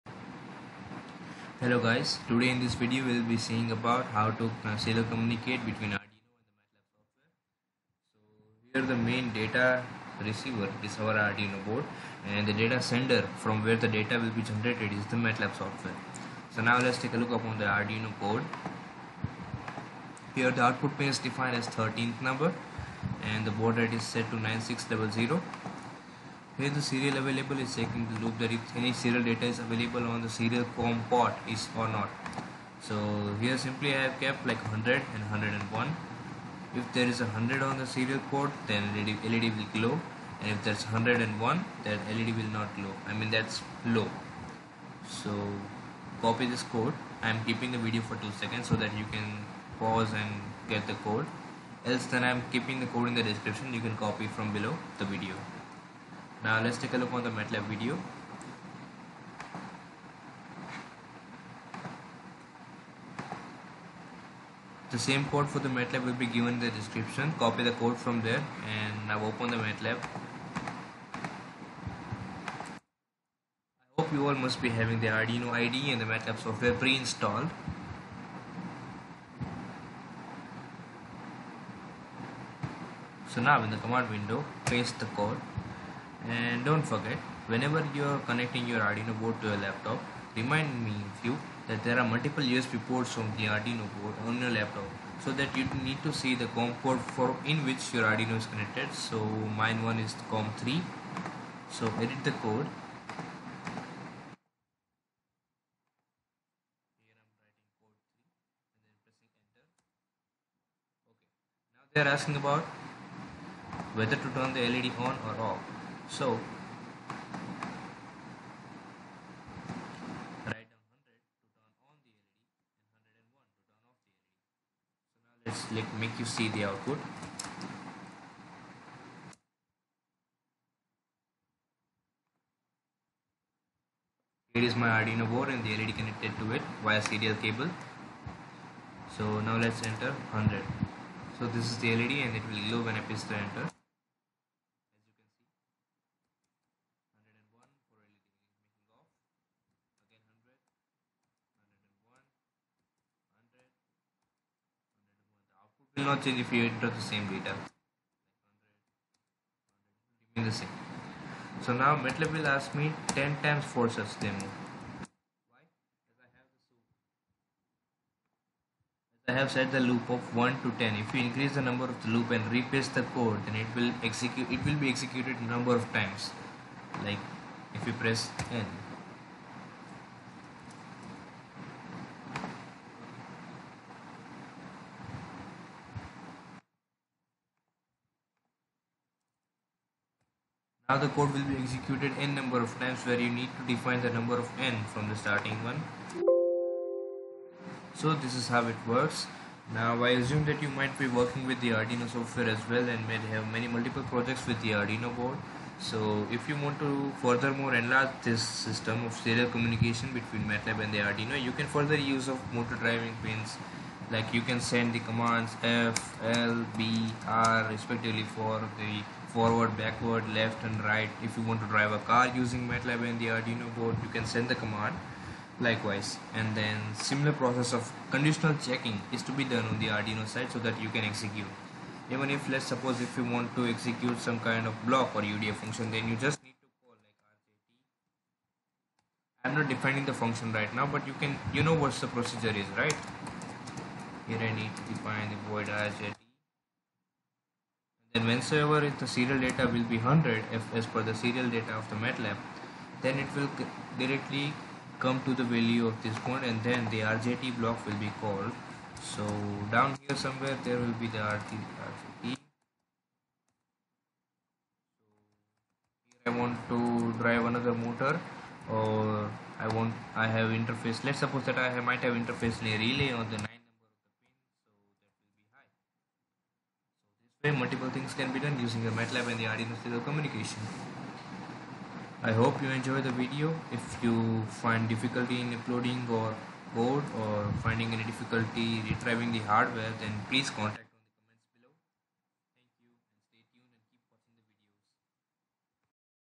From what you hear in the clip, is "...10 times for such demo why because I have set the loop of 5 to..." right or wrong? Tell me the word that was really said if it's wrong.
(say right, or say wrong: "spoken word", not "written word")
wrong: "1", not "5".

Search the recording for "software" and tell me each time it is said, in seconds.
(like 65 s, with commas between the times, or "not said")
8 s, 15 s, 76 s, 202 s.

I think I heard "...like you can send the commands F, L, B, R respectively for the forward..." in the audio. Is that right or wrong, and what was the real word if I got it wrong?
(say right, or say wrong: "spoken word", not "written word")
right.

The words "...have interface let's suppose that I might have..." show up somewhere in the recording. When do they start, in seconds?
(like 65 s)
270 s.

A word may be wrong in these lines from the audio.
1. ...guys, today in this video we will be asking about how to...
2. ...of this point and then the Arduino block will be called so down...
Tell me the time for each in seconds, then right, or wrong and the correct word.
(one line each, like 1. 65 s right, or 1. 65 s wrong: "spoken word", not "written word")
1. 1 s wrong: "seeing", not "asking"
2. 255 s wrong: "RJT", not "Arduino".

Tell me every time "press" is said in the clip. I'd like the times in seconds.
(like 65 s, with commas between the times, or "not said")
142 s, 177 s.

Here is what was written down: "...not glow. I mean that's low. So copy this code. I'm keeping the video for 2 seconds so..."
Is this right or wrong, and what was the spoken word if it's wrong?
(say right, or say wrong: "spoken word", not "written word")
right.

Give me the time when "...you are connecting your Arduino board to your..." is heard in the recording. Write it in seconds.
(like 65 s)
87 s.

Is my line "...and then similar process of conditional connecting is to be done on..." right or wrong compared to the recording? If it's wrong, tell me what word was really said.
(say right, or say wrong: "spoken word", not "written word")
wrong: "checking", not "connecting".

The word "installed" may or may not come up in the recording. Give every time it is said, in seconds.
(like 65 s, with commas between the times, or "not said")
76 s.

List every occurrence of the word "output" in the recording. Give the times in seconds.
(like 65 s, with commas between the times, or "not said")
20 s, 126 s.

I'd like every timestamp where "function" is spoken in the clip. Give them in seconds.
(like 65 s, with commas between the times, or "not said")
235 s, 240 s.